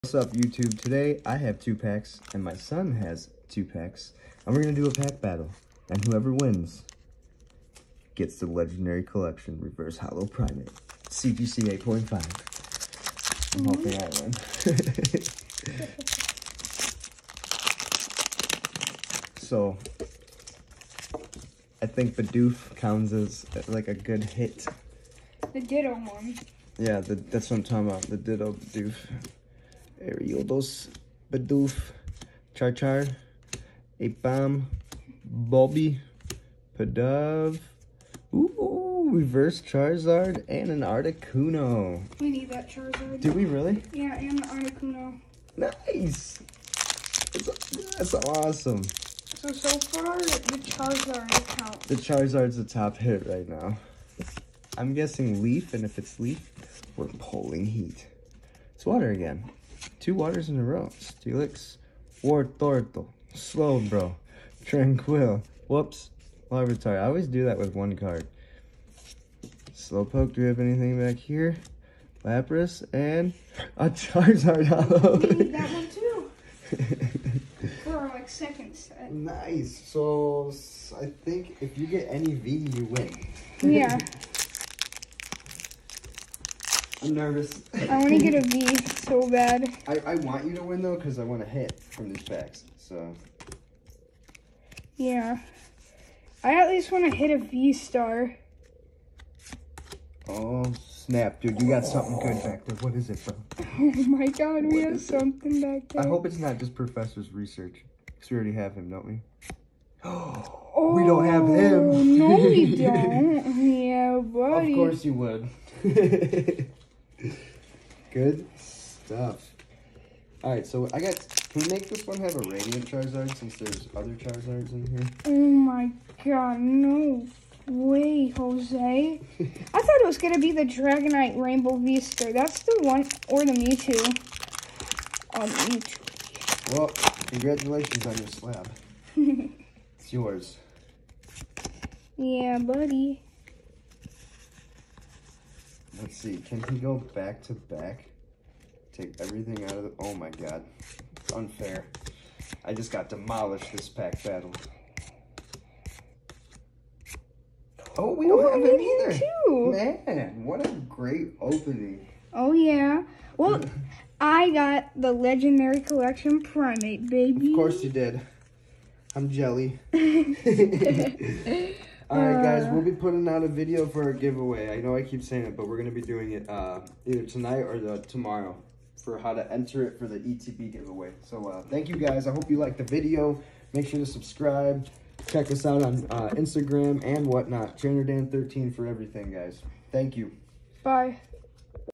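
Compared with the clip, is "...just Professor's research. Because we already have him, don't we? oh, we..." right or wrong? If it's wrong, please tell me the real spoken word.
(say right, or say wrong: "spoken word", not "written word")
right.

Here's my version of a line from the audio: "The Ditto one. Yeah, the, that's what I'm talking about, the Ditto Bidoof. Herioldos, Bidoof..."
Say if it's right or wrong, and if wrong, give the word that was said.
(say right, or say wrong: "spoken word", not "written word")
right.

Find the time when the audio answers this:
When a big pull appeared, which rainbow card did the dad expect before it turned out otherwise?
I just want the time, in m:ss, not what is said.
2:10.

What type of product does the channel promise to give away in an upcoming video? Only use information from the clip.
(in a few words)
ETB.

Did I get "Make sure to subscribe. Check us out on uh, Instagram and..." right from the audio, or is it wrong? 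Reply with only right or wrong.
right.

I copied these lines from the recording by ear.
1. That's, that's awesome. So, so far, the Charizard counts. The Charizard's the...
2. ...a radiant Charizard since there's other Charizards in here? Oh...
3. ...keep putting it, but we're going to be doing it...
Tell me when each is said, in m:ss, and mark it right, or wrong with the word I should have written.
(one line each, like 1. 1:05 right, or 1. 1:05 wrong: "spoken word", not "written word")
1. 0:47 right
2. 2:02 right
3. 2:55 wrong: "saying", not "putting".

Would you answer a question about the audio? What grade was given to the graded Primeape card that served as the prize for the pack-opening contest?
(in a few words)
CGC 8.5.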